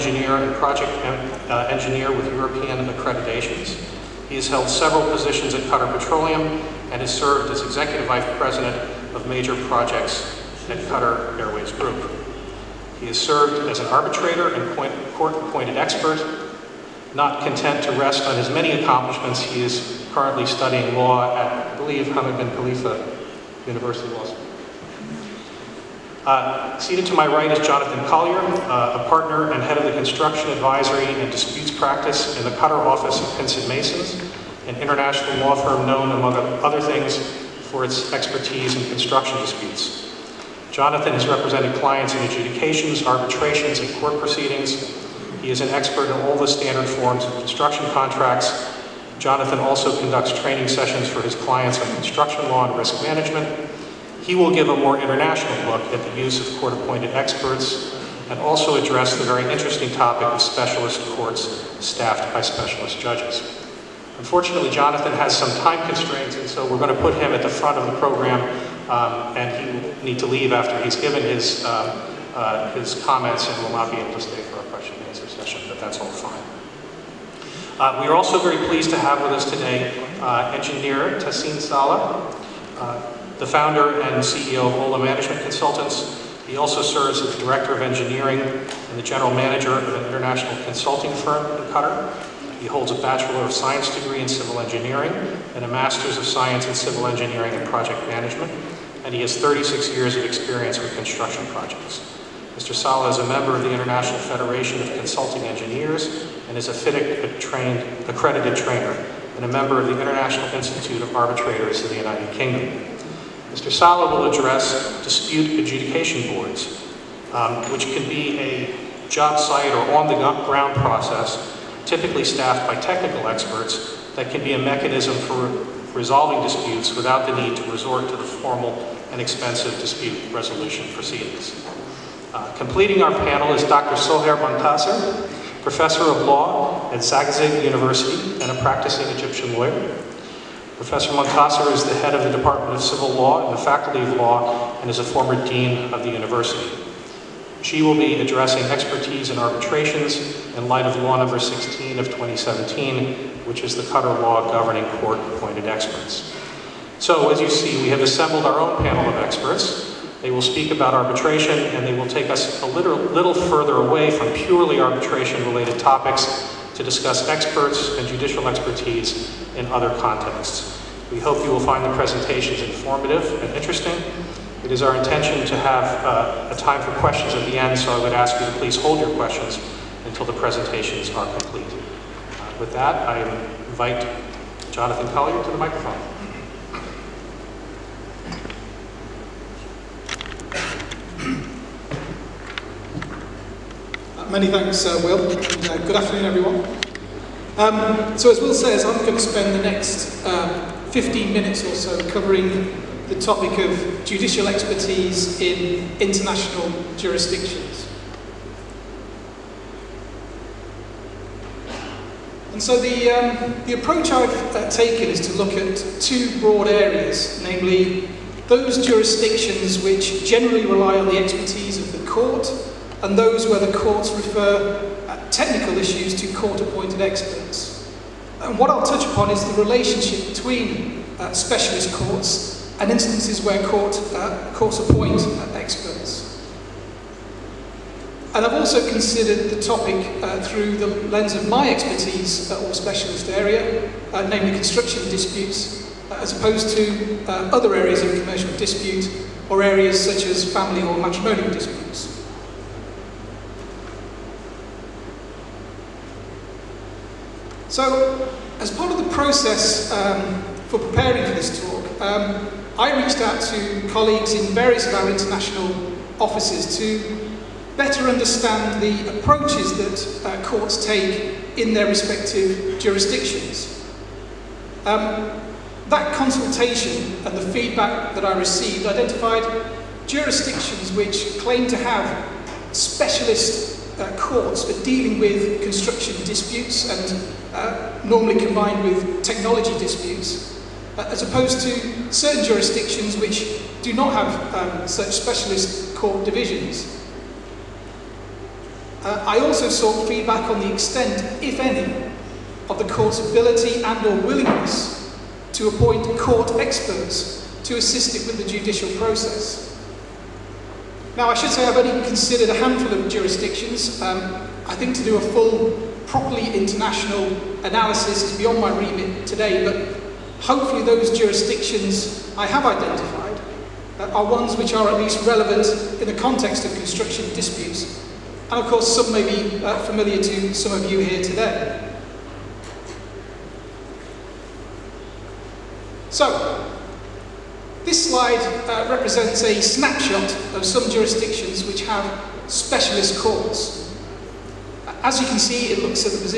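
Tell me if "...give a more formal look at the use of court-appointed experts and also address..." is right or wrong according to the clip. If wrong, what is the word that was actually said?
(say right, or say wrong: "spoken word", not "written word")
wrong: "international", not "formal".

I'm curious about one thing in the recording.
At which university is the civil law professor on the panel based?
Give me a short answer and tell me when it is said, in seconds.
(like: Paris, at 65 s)
Zagazig University, at 136 s.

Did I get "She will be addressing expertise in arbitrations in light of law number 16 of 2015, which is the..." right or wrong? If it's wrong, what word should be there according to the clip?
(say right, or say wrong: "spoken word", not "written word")
wrong: "2017", not "2015".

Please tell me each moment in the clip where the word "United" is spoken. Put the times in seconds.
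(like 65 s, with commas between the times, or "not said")
111 s.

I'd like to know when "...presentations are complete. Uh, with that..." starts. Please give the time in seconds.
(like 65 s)
180 s.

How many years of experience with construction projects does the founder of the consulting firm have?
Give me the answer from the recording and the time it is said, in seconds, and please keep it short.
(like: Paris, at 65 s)
36, at 99 s.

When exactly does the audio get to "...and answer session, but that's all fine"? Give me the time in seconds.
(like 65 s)
74 s.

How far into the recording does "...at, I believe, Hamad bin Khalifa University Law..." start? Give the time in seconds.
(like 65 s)
21 s.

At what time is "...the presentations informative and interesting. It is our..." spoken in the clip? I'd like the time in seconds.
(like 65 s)
171 s.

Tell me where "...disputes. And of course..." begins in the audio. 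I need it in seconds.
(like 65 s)
327 s.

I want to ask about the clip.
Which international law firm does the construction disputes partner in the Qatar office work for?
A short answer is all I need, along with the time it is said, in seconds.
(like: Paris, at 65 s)
Pinsent Masons, at 33 s.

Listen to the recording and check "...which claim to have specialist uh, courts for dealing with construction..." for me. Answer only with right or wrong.
right.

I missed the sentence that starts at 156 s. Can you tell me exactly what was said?
So as you see, we have assembled our own panel of experts.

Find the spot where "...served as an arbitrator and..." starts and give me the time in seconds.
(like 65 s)
13 s.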